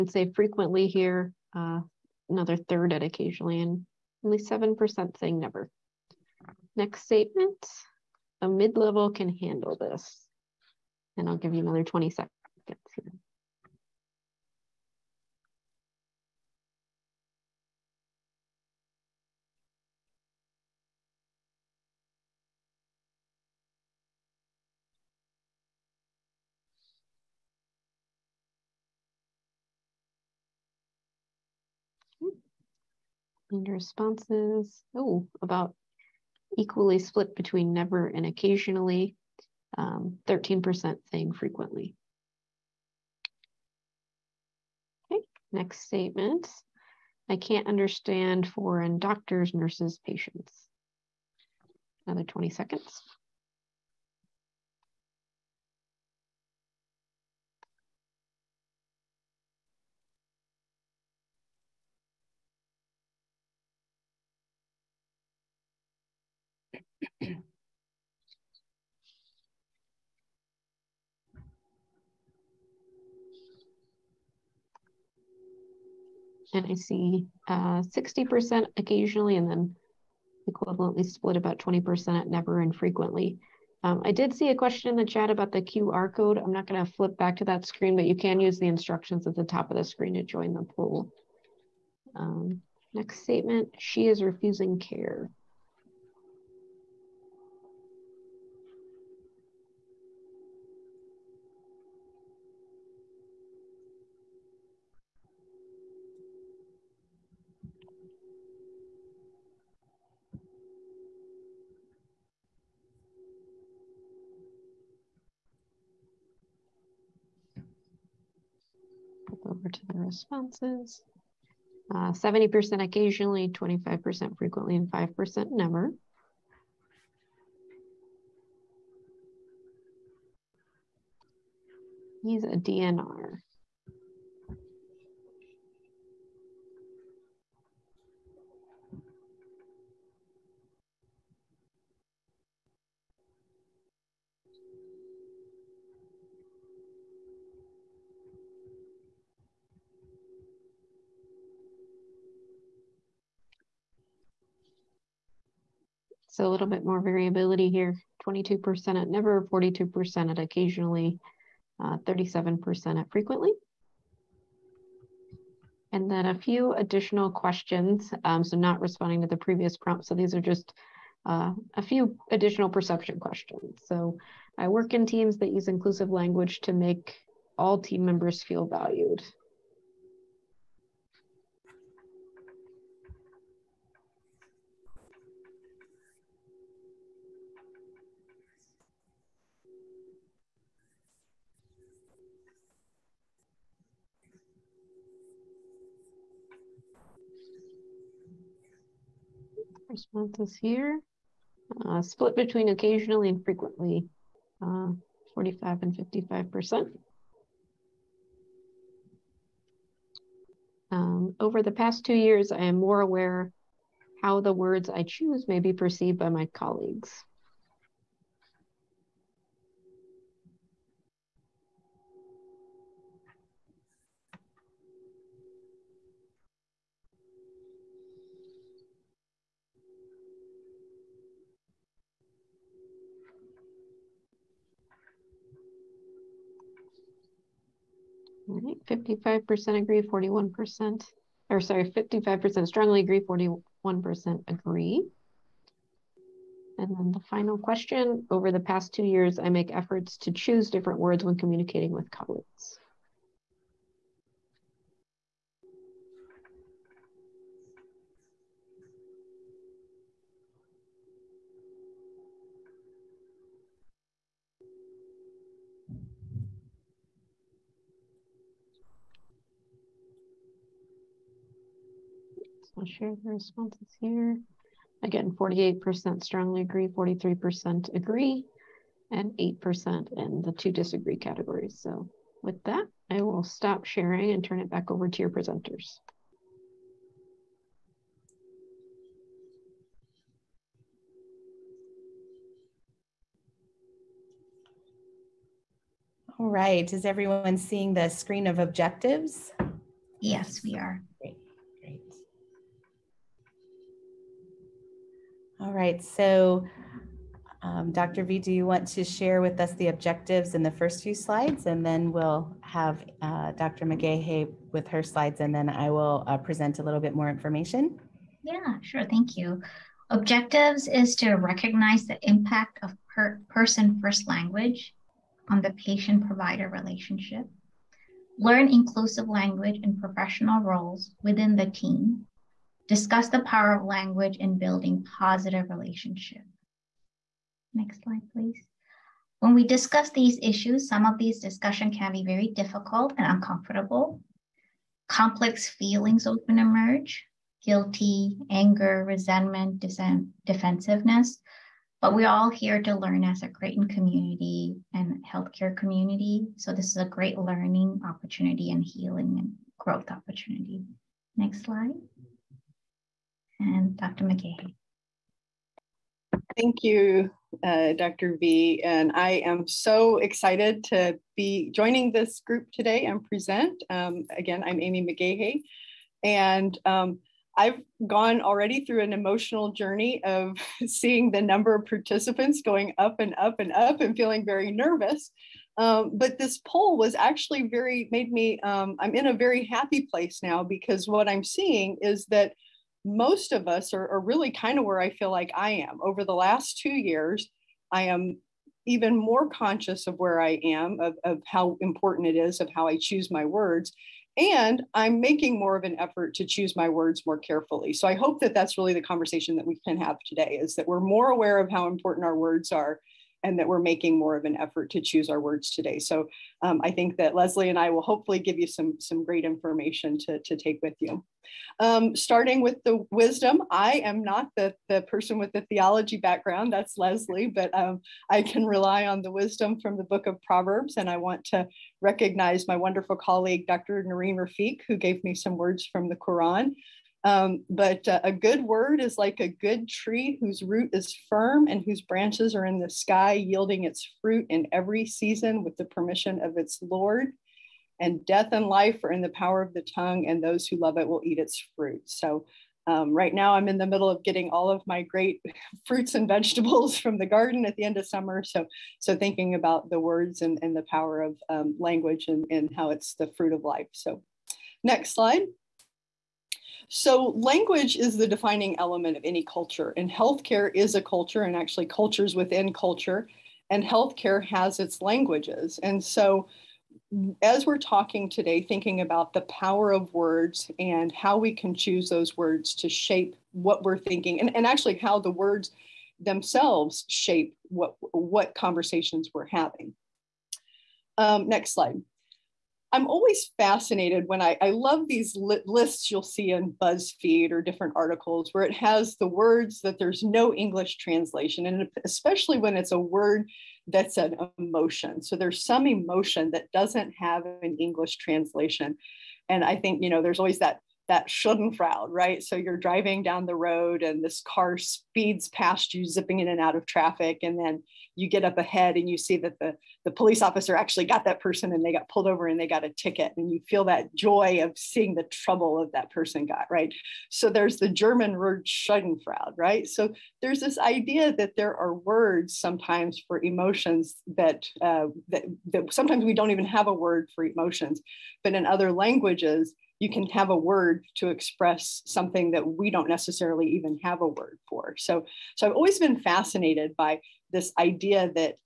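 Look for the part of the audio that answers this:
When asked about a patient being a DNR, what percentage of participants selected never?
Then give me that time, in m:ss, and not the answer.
2:38.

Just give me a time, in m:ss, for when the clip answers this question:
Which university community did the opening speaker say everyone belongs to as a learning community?
5:53.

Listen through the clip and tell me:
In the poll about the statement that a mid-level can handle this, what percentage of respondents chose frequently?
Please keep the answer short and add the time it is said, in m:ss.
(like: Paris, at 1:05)
13%, at 0:39.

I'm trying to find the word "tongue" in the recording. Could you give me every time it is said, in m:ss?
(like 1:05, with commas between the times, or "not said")
7:29.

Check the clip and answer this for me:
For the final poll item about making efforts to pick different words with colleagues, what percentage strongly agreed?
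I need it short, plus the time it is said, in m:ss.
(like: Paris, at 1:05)
48%, at 4:35.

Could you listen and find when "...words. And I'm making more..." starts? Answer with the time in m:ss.
6:43.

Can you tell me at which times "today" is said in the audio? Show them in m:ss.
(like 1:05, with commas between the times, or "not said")
6:12, 6:50, 6:55, 7:58.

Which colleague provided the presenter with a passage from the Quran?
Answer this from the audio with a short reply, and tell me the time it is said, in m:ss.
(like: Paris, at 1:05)
Dr. Nareen Rafiq, at 7:13.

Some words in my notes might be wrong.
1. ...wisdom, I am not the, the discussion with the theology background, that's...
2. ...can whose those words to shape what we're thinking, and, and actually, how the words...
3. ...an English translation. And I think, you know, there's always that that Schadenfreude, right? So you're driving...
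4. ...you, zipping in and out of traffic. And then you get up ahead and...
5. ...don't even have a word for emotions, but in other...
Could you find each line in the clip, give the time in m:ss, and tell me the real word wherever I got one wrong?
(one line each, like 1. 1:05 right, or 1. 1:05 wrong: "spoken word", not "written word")
1. 7:03 wrong: "person", not "discussion"
2. 8:01 wrong: "choose", not "whose"
3. 8:27 right
4. 8:35 right
5. 8:56 right.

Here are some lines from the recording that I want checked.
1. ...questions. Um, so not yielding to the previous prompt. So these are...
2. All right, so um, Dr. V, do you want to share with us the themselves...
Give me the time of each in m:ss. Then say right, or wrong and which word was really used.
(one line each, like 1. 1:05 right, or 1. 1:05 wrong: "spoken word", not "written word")
1. 2:47 wrong: "responding", not "yielding"
2. 5:05 wrong: "objectives", not "themselves".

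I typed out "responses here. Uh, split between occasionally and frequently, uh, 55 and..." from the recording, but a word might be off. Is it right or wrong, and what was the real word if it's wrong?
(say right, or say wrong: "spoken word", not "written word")
wrong: "45", not "55".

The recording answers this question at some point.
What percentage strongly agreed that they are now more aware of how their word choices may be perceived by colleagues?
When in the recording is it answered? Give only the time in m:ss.
4:01.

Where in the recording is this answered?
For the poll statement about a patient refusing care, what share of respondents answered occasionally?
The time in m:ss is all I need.
2:01.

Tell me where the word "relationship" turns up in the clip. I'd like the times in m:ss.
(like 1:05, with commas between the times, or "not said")
5:26, 5:35.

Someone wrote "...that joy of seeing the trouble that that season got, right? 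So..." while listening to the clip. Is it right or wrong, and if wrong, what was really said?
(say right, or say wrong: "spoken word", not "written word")
wrong: "person", not "season".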